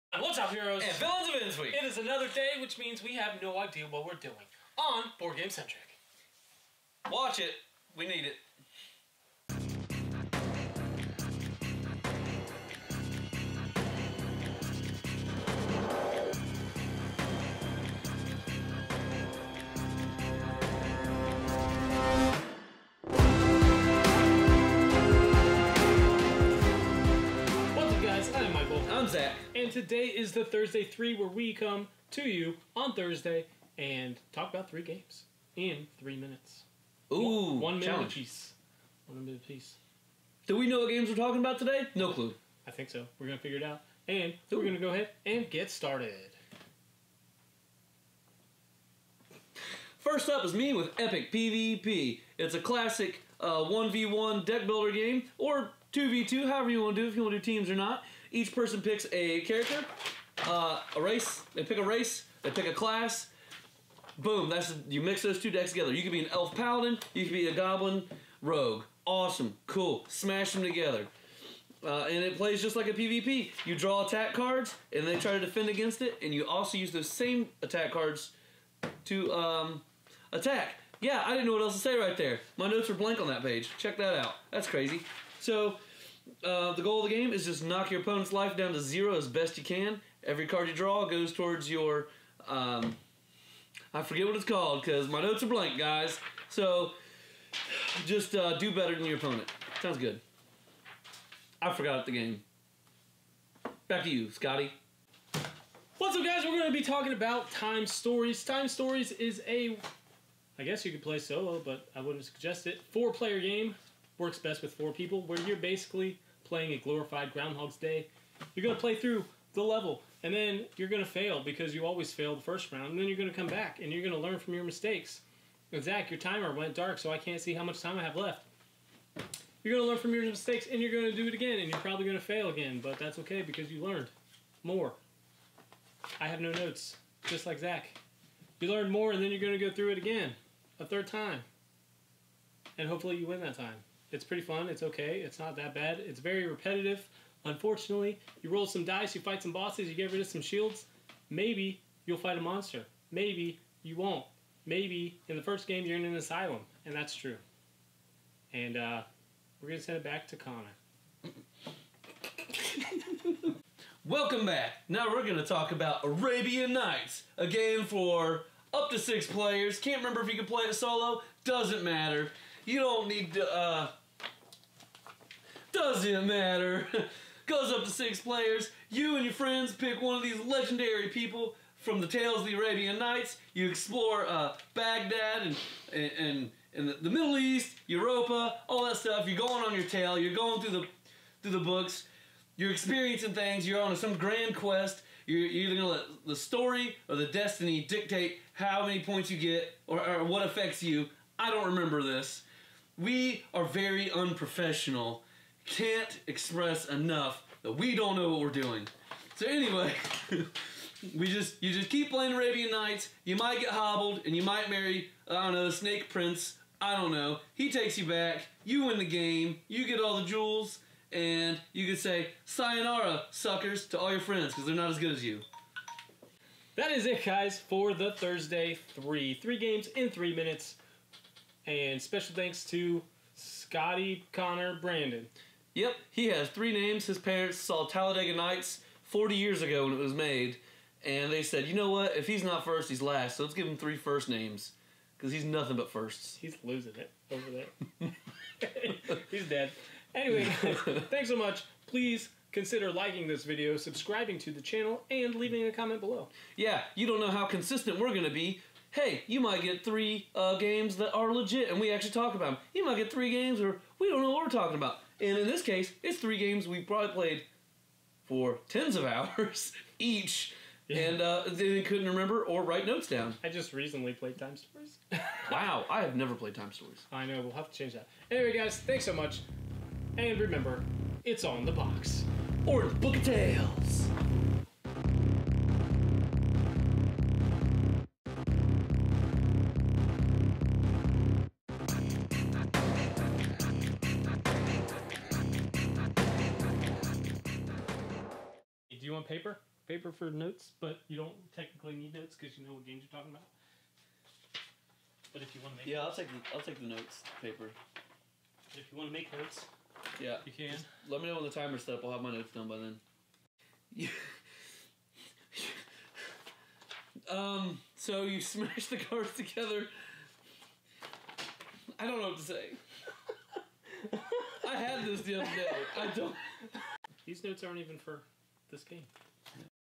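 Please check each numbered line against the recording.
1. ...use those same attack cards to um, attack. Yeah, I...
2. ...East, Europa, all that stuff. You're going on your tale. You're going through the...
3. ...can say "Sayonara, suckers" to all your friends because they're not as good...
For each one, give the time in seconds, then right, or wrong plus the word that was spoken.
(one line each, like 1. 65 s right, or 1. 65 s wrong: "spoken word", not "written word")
1. 76 s right
2. 187 s right
3. 221 s right.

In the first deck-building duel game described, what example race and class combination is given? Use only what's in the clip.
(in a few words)
goblin rogue.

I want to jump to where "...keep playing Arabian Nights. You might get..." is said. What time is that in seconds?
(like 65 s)
211 s.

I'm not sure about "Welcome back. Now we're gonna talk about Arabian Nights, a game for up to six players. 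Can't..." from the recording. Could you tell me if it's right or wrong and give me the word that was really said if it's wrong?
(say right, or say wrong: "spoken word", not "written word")
right.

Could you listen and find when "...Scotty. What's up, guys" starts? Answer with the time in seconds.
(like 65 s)
104 s.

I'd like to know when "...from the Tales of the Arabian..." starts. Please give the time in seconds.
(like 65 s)
181 s.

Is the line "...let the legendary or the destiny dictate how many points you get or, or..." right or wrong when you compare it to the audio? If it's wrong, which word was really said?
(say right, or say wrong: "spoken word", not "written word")
wrong: "story", not "legendary".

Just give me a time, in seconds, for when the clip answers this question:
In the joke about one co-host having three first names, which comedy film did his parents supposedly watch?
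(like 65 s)
237 s.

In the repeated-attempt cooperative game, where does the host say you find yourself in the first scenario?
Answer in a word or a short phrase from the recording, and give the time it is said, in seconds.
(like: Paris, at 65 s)
an asylum, at 156 s.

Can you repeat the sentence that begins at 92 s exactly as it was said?
Um, I forget what it's called because my notes are blank, guys.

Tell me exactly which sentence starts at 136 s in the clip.
I have no notes, just like Zach.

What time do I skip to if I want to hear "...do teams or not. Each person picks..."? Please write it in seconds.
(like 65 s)
57 s.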